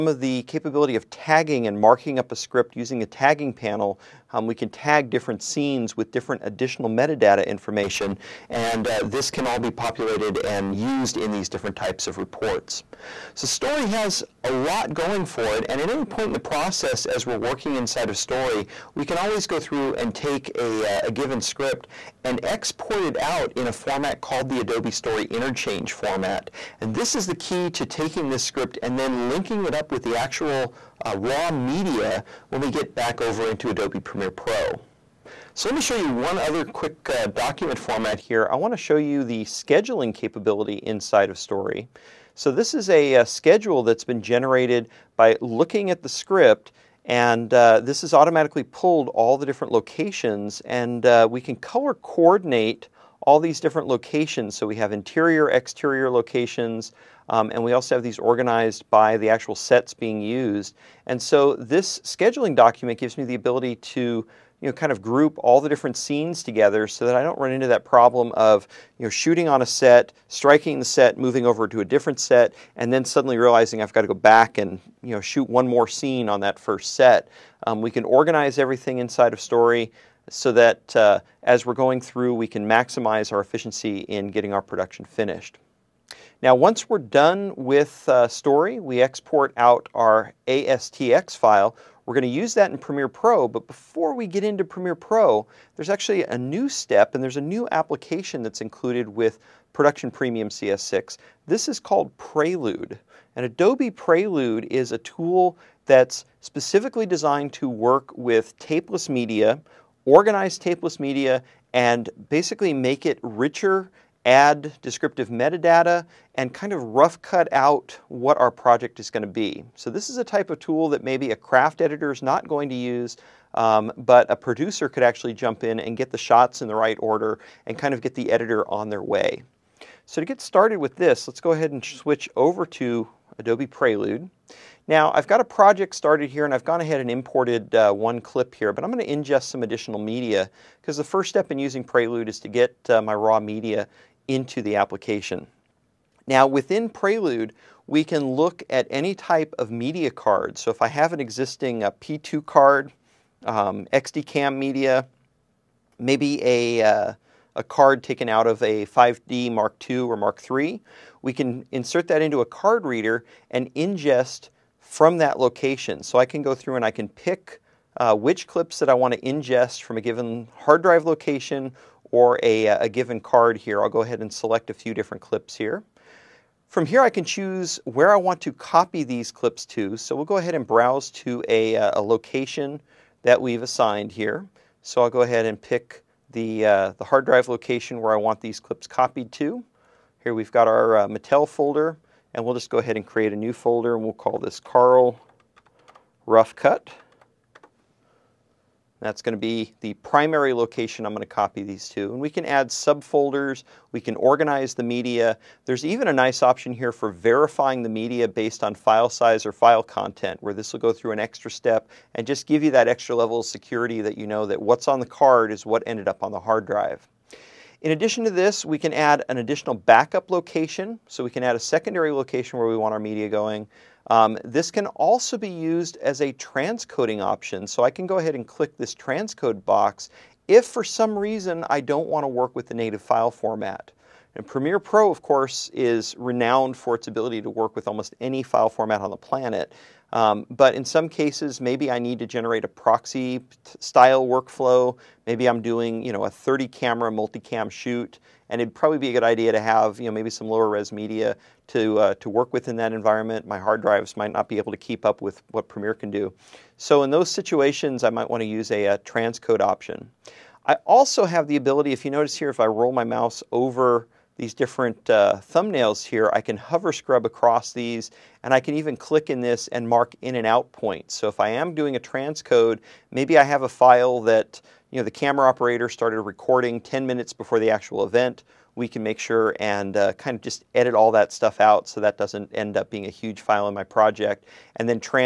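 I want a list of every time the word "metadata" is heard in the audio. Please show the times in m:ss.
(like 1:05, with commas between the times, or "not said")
0:06, 1:55.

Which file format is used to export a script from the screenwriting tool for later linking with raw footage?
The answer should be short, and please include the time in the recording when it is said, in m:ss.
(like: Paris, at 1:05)
Adobe Story Interchange format, at 0:24.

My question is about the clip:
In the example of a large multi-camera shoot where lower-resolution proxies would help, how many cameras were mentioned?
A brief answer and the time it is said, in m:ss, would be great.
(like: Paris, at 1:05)
30, at 4:06.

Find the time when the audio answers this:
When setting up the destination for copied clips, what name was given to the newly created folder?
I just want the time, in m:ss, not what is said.
3:14.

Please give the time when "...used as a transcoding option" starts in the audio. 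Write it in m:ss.
3:45.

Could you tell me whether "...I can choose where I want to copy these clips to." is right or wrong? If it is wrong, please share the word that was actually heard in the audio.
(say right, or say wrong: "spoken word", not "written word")
right.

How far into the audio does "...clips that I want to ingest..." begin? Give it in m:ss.
2:48.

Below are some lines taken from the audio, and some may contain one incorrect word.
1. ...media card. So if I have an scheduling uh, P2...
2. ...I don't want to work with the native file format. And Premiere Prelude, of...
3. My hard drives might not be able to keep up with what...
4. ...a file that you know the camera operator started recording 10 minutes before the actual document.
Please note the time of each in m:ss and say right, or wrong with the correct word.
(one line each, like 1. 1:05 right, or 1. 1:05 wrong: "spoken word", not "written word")
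1. 2:29 wrong: "existing", not "scheduling"
2. 3:51 wrong: "Pro", not "Prelude"
3. 4:13 right
4. 4:33 wrong: "event", not "document".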